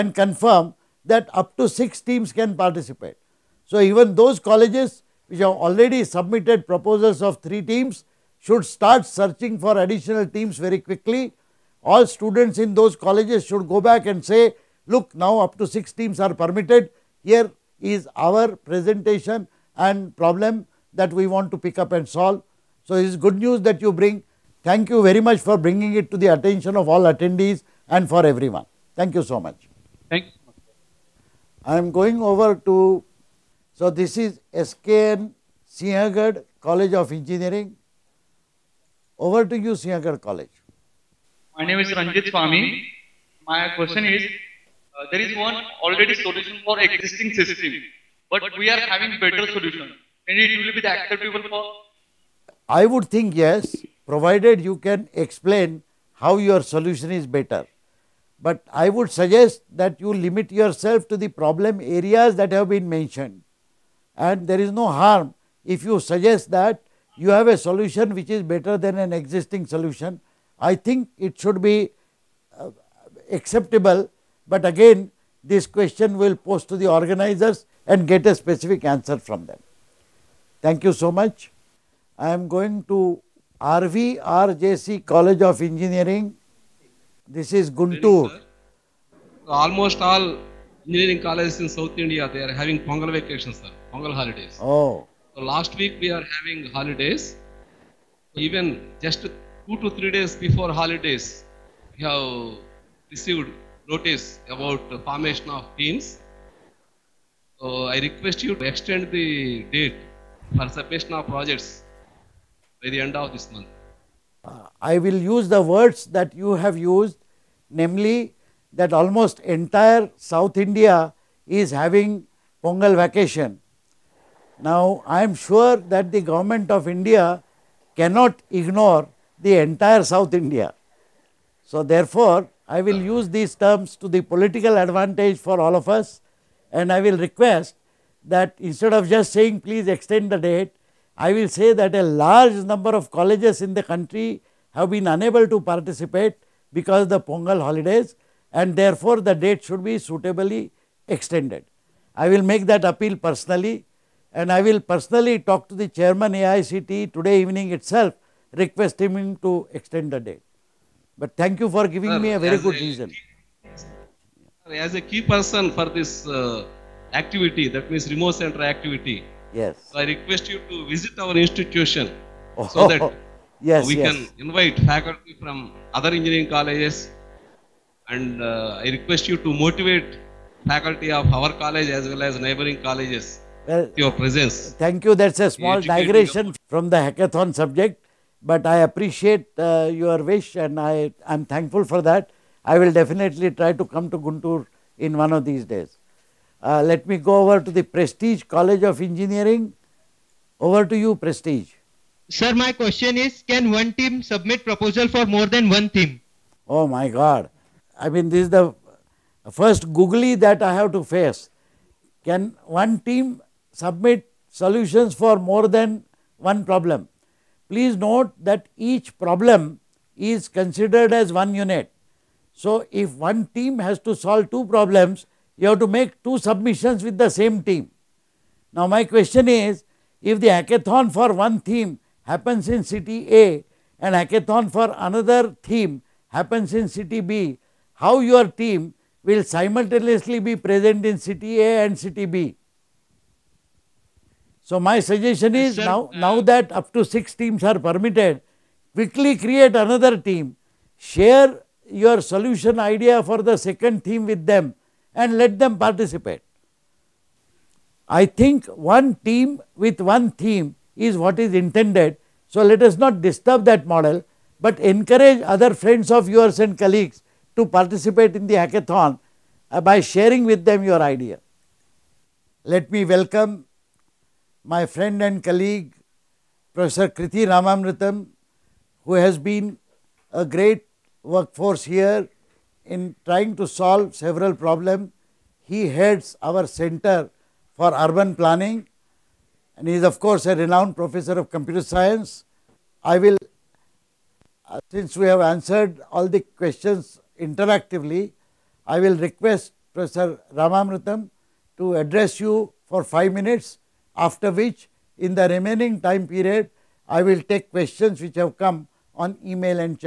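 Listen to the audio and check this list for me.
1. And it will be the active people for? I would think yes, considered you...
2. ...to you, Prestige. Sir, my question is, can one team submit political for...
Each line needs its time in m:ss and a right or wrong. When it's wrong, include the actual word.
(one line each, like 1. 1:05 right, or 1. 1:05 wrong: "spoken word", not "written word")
1. 0:50 wrong: "provided", not "considered"
2. 3:20 wrong: "proposal", not "political".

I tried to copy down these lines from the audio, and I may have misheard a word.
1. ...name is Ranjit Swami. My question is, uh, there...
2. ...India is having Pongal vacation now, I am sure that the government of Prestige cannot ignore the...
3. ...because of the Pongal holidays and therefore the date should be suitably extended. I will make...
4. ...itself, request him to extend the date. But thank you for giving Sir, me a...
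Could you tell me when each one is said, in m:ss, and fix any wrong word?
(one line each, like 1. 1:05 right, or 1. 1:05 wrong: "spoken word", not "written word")
1. 0:41 right
2. 2:00 wrong: "India", not "Prestige"
3. 2:26 right
4. 2:37 right.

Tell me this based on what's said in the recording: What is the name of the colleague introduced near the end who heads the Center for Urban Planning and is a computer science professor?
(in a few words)
Krithi Ramamritham.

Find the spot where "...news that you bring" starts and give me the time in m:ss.
0:23.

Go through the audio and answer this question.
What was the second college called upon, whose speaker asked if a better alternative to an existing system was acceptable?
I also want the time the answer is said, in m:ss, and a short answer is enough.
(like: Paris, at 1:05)
SKN Sinhagad College of Engineering, at 0:34.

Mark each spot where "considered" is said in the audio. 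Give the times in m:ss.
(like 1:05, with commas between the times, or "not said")
3:40.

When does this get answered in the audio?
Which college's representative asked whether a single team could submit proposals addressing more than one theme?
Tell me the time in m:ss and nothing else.
3:17.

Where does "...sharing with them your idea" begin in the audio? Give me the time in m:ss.
4:30.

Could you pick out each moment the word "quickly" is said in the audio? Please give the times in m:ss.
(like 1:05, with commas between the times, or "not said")
0:10, 4:08.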